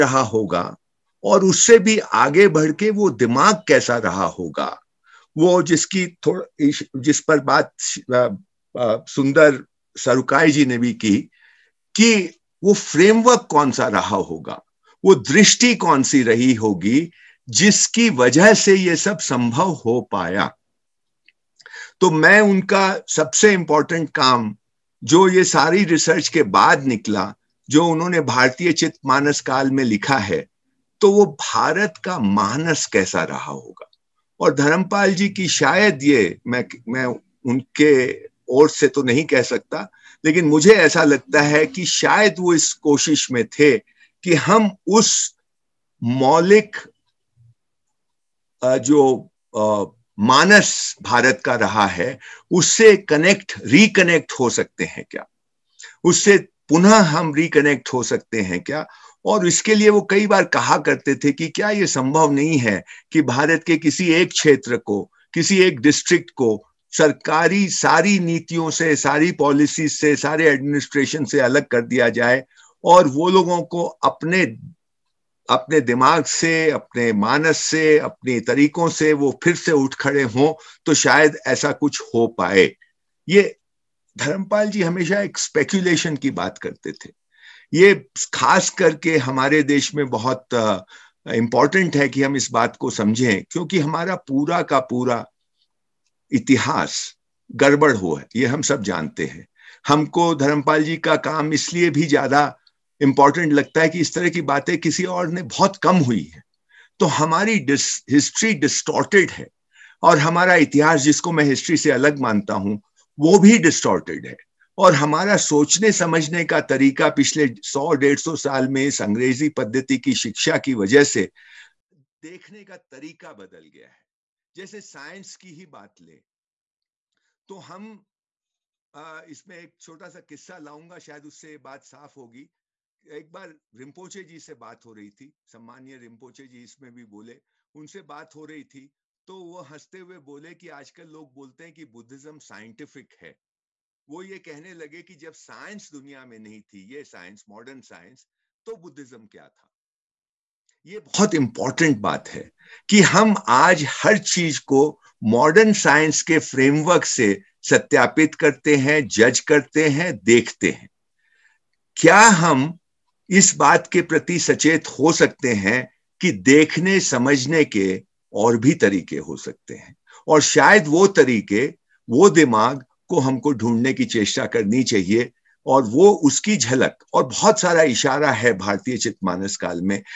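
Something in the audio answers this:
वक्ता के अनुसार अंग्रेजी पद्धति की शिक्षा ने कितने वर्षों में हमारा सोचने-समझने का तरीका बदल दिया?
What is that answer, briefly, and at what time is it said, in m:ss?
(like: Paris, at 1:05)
सौ डेढ़ सौ साल, at 1:57.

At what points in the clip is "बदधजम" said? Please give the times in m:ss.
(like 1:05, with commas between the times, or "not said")
2:21, 2:28.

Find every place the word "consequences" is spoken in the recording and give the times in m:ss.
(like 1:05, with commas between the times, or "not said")
not said.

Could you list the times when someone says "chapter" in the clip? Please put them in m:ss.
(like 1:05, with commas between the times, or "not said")
not said.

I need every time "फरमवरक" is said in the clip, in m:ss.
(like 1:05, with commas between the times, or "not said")
0:12, 2:36.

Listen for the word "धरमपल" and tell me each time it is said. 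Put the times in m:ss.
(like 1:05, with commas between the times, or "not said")
0:34, 1:24, 1:40.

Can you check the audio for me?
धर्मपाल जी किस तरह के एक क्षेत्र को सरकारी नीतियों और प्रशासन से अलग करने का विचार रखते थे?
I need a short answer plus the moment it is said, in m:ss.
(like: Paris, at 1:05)
डिस्ट्रिक्ट, at 1:05.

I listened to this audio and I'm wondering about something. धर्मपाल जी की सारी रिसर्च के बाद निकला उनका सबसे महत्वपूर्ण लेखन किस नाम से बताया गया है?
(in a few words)
भारतीय चित मानस काल.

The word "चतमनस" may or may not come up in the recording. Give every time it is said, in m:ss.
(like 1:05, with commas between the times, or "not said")
2:58.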